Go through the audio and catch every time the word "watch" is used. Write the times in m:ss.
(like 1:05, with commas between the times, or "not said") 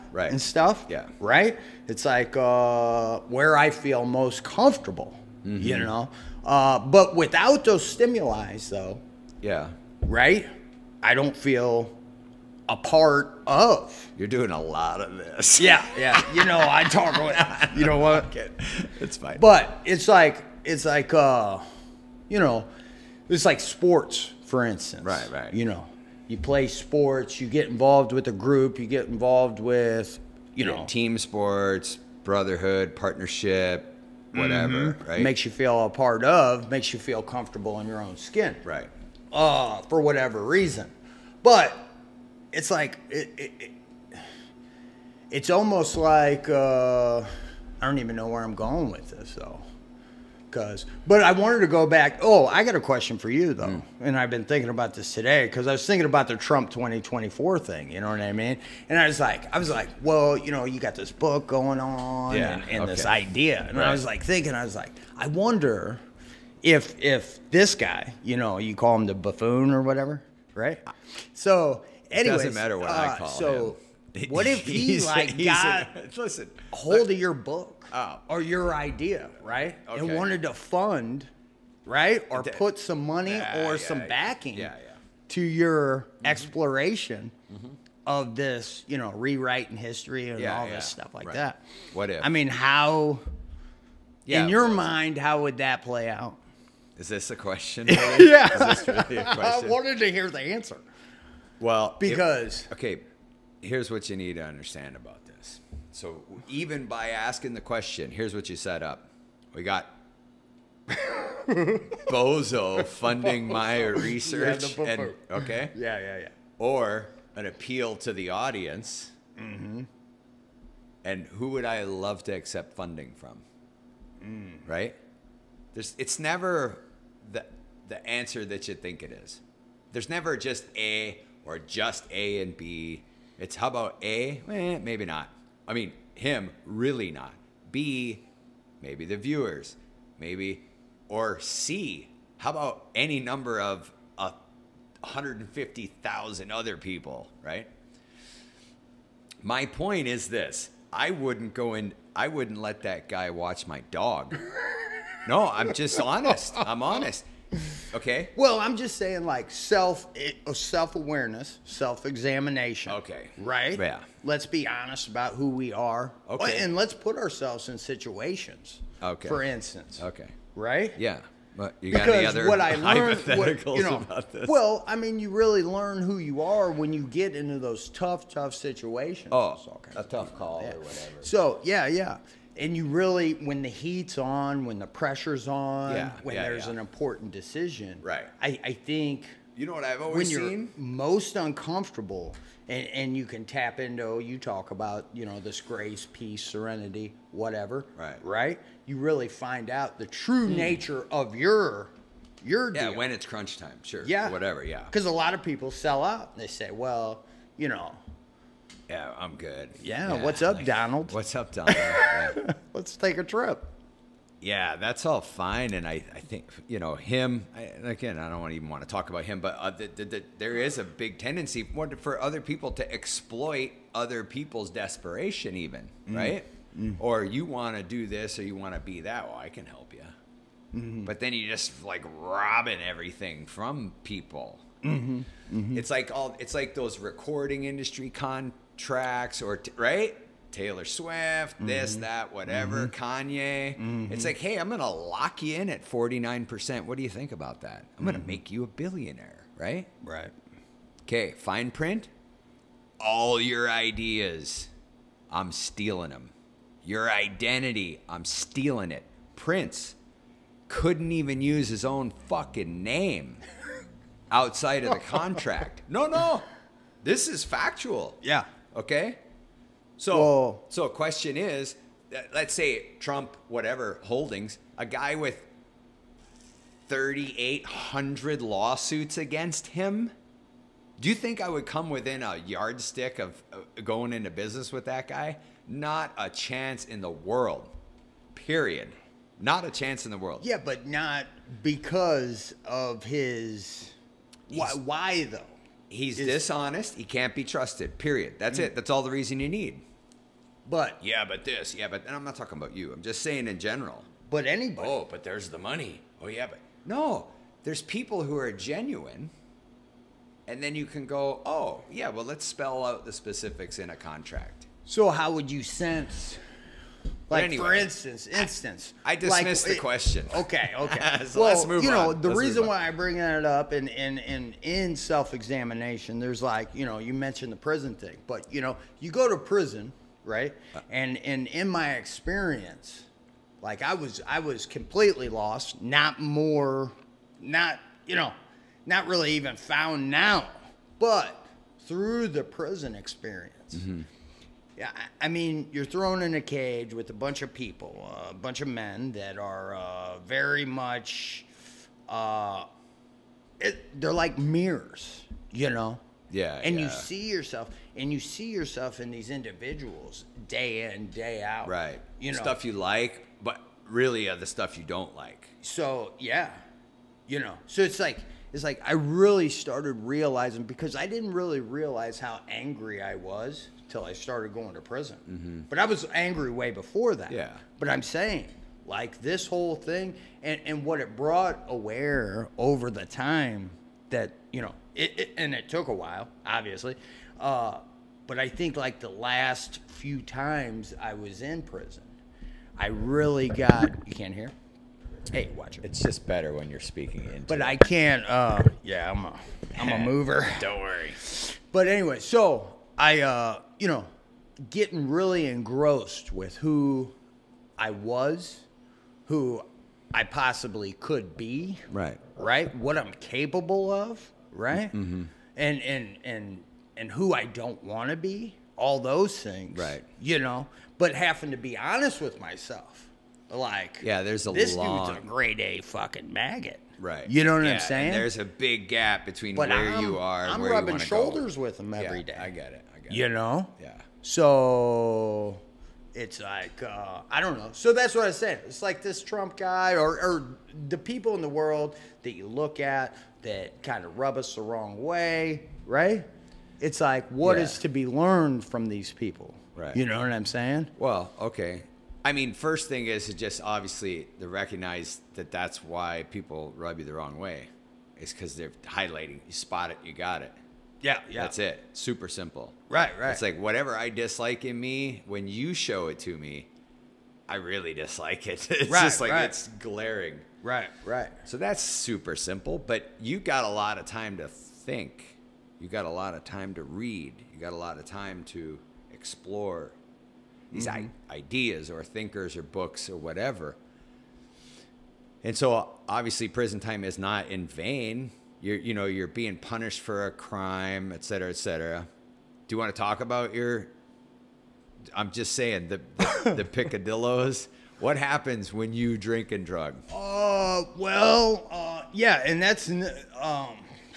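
2:33, 6:35.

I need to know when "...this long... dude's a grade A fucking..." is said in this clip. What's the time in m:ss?
7:04.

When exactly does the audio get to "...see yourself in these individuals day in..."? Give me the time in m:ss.
5:58.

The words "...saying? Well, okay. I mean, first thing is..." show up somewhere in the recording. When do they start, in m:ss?
7:30.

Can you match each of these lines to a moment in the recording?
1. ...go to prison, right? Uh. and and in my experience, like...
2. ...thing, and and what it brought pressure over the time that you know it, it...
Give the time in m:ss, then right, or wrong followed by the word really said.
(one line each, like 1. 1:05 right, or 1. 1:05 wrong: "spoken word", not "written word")
1. 5:29 right
2. 6:19 wrong: "aware", not "pressure".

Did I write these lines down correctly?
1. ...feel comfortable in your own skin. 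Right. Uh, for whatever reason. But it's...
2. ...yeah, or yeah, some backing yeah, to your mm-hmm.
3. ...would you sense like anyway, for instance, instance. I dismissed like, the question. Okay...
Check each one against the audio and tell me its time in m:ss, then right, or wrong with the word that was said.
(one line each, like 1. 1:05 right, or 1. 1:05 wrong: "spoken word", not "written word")
1. 0:36 right
2. 1:23 right
3. 5:15 right.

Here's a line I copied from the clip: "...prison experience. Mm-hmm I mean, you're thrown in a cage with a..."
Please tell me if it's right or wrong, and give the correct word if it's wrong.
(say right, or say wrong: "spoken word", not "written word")
right.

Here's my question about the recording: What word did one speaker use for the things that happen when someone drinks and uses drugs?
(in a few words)
Picadillos.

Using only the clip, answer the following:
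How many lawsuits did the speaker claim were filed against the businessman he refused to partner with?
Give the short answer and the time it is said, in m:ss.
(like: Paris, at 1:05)
3,800, at 4:36.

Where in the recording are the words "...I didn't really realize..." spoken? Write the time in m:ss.
6:10.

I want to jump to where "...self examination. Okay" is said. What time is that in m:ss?
2:41.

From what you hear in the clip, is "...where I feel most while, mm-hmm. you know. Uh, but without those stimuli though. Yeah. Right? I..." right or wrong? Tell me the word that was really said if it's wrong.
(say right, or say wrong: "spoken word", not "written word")
wrong: "comfortable", not "while".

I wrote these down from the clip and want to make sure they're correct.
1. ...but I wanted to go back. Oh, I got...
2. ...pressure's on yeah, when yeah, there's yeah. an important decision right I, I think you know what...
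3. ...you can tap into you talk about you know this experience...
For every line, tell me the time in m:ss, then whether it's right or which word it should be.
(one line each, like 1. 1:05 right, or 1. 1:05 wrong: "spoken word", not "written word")
1. 0:51 right
2. 3:04 right
3. 3:13 wrong: "grace", not "experience".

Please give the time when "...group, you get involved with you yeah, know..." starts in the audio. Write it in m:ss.
0:28.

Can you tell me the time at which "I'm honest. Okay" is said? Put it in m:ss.
2:36.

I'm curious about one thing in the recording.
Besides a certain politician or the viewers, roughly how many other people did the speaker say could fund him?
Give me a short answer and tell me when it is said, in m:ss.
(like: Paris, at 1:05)
150,000, at 2:25.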